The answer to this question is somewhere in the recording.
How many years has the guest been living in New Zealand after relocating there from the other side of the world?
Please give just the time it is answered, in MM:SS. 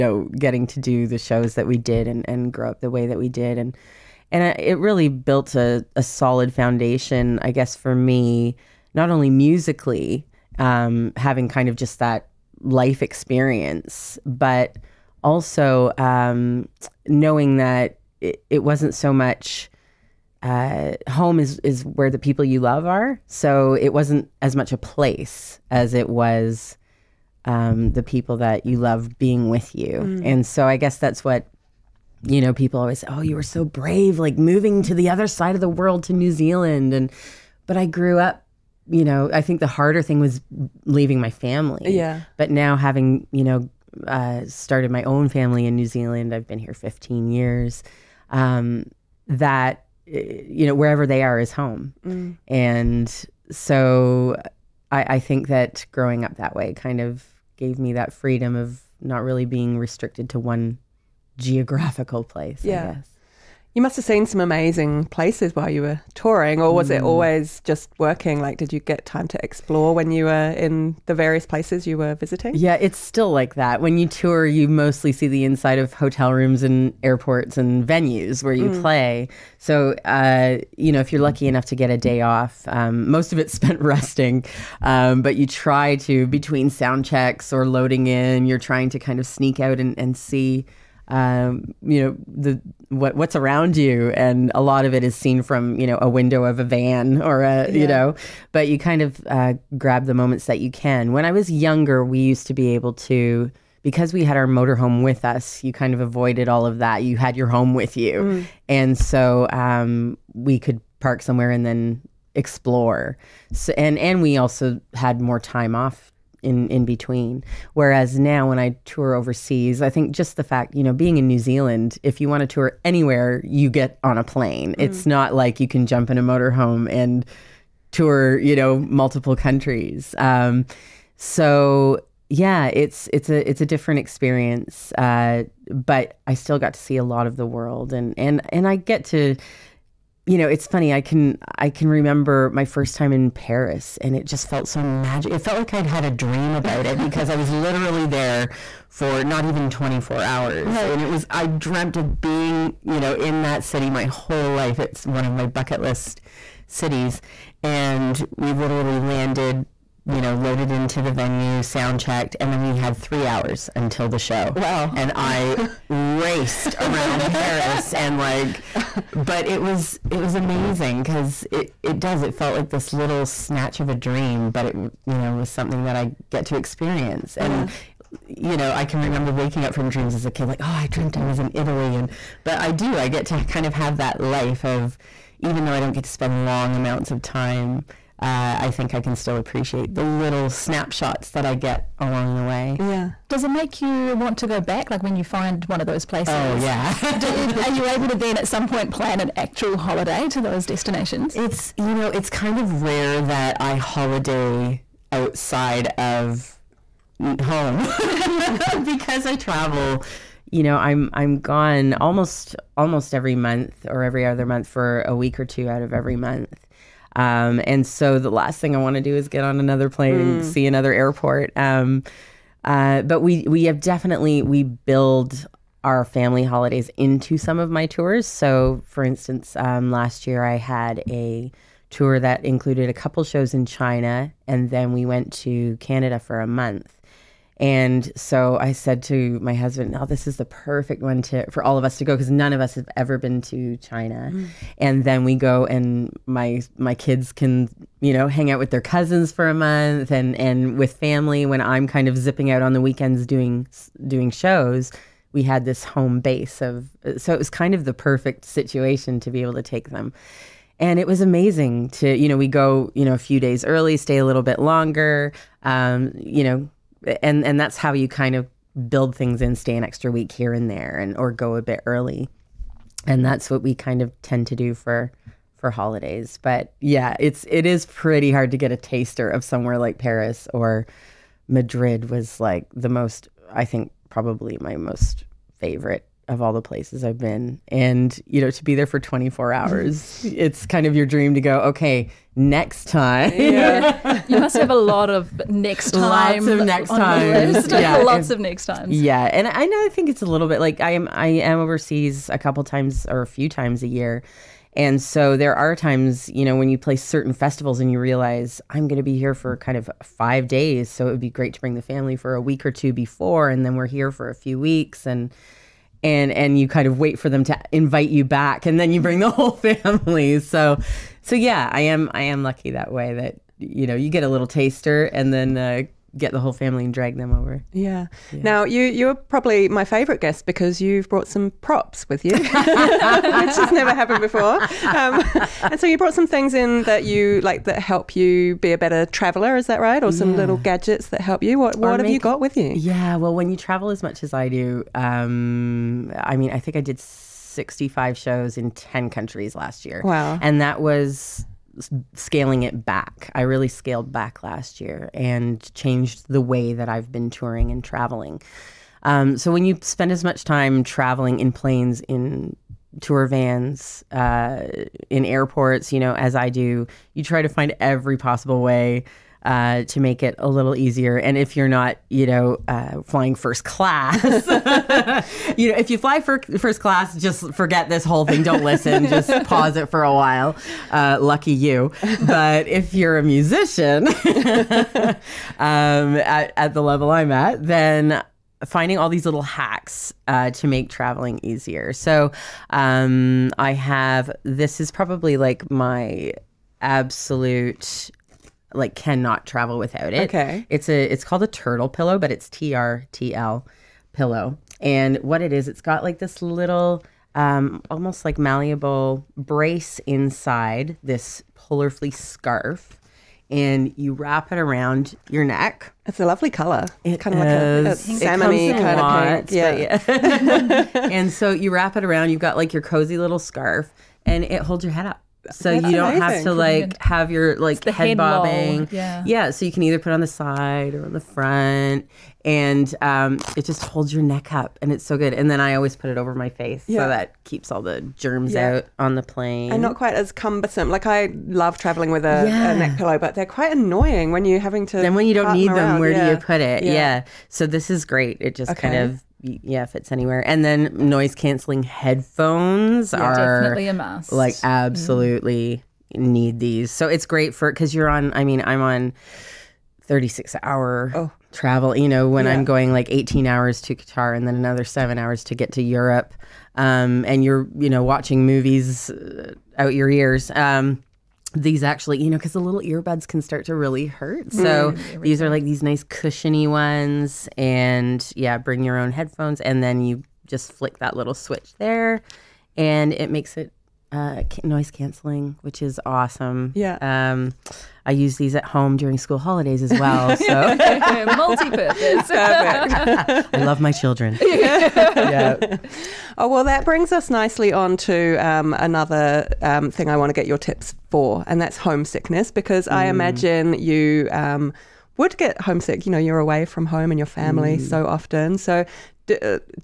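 00:46.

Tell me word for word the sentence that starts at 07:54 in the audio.
So mm, these are like these nice cushiony ones.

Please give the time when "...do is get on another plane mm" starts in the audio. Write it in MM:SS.
03:39.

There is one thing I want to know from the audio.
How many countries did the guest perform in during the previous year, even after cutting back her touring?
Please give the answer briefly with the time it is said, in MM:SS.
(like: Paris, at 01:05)
10, at 05:48.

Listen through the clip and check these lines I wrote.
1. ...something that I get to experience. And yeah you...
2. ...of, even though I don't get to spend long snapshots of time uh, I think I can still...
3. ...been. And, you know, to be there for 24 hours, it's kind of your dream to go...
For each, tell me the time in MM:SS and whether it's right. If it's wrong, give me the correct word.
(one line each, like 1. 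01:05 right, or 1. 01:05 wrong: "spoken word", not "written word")
1. 02:55 right
2. 03:04 wrong: "amounts", not "snapshots"
3. 04:47 right.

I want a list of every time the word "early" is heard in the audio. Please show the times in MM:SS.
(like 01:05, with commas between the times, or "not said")
04:23, 04:31.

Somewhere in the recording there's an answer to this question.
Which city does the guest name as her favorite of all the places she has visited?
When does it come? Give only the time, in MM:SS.
04:41.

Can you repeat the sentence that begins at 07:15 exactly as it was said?
And then I always put it over my face, yeah.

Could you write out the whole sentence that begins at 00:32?
People always, say, oh, you were so brave, like moving to the other side of the world to New Zealand.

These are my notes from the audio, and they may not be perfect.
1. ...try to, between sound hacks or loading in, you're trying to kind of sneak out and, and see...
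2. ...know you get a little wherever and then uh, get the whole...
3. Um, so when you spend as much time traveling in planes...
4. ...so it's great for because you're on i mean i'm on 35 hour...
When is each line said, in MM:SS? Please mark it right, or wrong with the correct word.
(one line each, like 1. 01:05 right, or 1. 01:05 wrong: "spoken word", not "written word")
1. 01:25 wrong: "checks", not "hacks"
2. 05:23 wrong: "taster", not "wherever"
3. 05:59 right
4. 07:36 wrong: "36", not "35".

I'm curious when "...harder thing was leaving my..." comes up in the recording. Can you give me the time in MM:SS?
00:39.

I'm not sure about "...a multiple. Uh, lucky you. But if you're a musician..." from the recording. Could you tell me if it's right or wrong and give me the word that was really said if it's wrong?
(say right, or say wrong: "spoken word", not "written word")
wrong: "while", not "multiple".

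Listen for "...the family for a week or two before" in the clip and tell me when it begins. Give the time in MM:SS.
05:11.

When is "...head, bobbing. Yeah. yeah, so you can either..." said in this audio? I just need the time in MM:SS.
07:07.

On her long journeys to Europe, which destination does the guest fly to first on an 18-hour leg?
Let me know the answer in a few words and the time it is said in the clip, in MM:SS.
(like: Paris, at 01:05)
Qatar, at 07:43.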